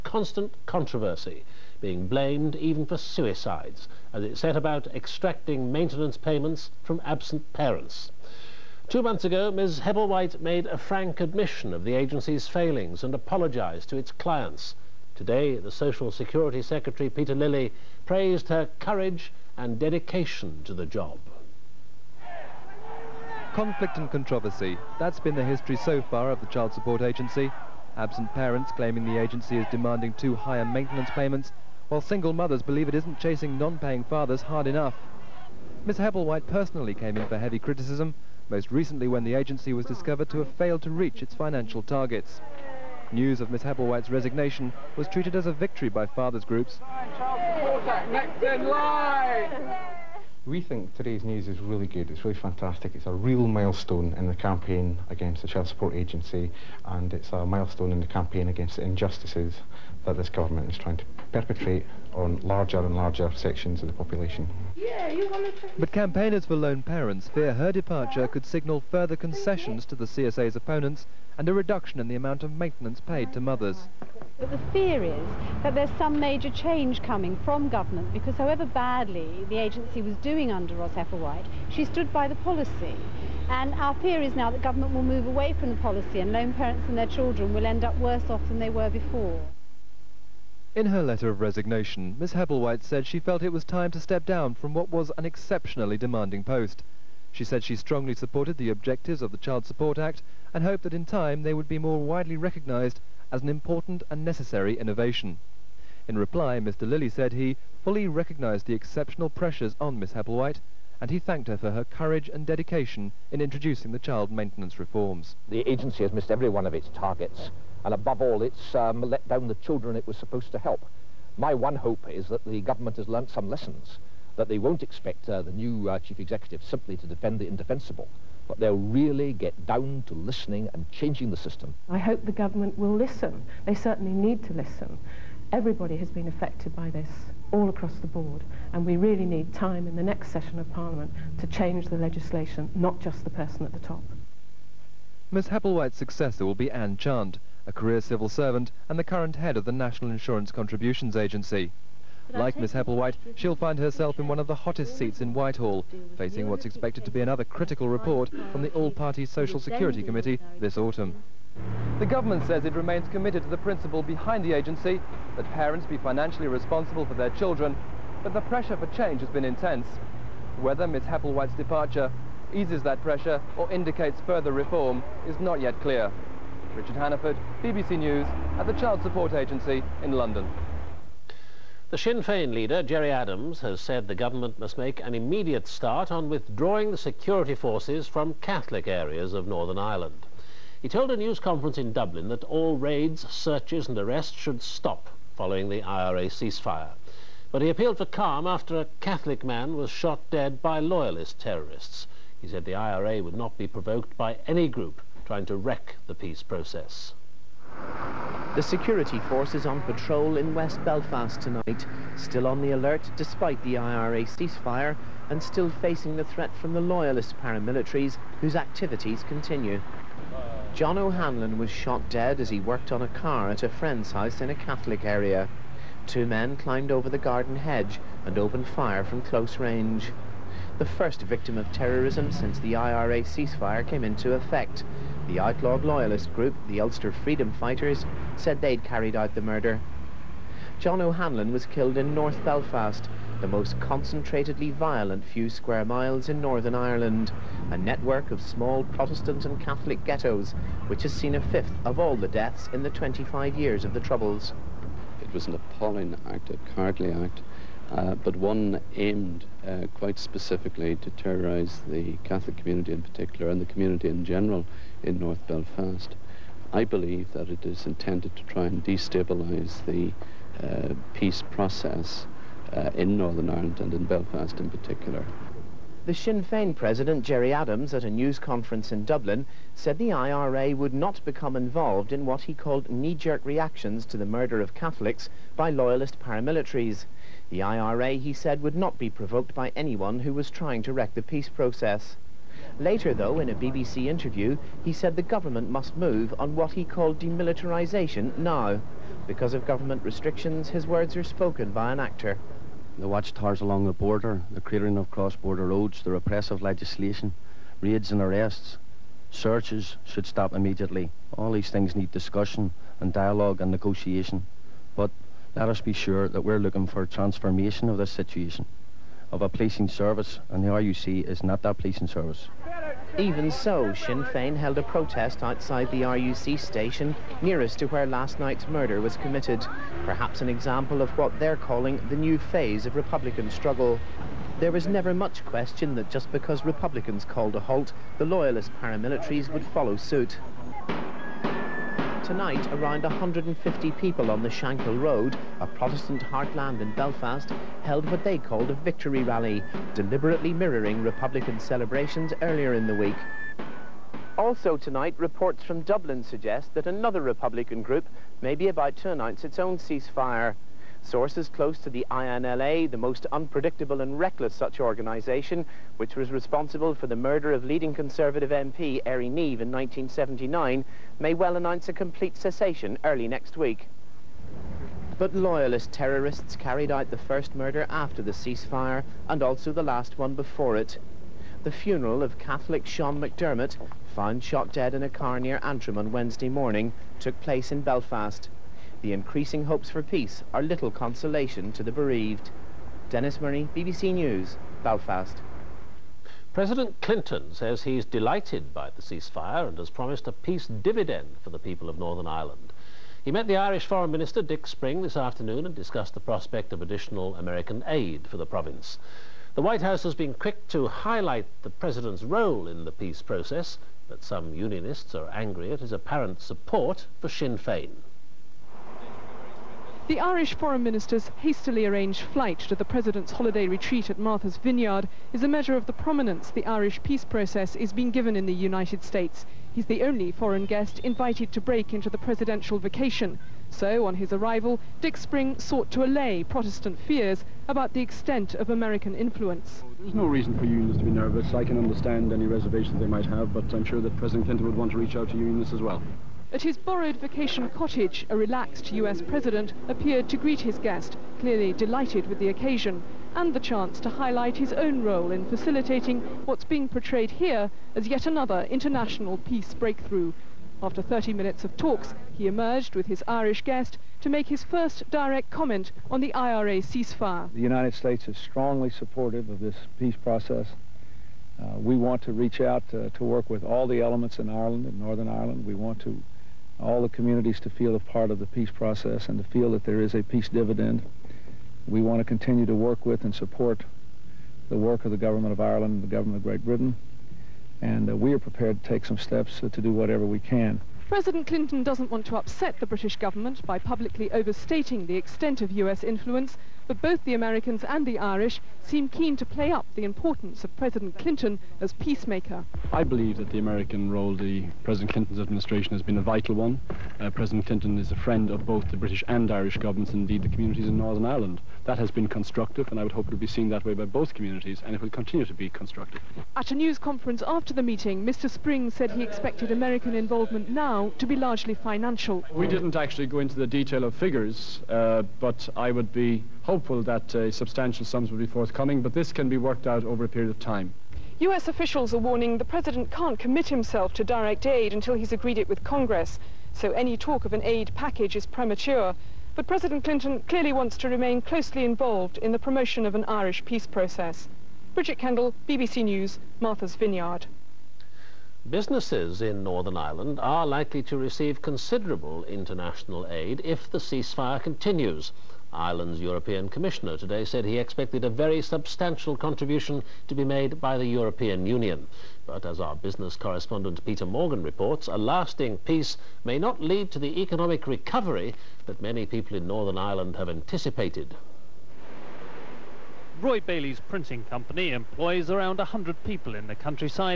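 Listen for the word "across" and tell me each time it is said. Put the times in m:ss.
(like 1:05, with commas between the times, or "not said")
2:17.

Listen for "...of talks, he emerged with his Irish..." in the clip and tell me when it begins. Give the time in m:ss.
7:41.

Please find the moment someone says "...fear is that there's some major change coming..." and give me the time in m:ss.
1:14.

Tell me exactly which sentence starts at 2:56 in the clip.
Richard Hannaford, BBC News, at the Child Support Agency in London.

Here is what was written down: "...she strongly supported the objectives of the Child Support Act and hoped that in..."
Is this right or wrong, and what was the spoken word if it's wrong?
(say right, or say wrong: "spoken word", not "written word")
right.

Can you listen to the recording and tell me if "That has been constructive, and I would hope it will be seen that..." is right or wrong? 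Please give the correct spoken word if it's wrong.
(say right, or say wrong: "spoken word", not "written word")
right.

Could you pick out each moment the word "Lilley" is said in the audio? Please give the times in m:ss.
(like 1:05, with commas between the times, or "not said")
0:17, 1:46.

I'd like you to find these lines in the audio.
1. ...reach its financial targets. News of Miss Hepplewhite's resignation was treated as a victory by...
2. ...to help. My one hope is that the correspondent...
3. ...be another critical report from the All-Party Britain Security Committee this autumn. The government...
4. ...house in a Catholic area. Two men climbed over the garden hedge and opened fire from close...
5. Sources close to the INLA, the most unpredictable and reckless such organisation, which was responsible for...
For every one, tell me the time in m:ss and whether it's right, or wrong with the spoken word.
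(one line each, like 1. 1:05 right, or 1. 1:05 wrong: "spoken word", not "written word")
1. 0:40 right
2. 2:00 wrong: "government", not "correspondent"
3. 2:37 wrong: "Social", not "Britain"
4. 3:44 right
5. 6:01 right.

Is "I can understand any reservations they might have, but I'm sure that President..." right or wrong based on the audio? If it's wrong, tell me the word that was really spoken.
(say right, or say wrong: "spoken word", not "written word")
right.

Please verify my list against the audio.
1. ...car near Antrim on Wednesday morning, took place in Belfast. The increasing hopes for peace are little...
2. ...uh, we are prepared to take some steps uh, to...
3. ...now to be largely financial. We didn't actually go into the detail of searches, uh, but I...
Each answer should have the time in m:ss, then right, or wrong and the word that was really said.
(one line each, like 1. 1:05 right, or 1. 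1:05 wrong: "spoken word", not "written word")
1. 6:25 right
2. 8:08 right
3. 8:40 wrong: "figures", not "searches".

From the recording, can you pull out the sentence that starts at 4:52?
Later, though, in a BBC interview, he said the government must move on what he called demilitarisation now.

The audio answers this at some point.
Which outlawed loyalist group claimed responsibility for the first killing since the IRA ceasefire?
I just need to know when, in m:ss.
3:56.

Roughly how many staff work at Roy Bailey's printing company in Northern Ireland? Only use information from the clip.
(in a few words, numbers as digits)
100.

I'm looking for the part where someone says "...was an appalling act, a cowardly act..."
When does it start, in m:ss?
4:15.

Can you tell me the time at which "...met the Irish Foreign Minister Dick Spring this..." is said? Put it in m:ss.
6:43.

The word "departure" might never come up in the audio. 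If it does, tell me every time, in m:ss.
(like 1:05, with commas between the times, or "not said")
1:07, 2:51.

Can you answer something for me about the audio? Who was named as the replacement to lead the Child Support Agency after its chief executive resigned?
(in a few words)
Anne Chant.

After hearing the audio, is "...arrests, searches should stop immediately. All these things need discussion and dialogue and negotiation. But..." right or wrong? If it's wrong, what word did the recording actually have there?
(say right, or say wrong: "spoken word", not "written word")
right.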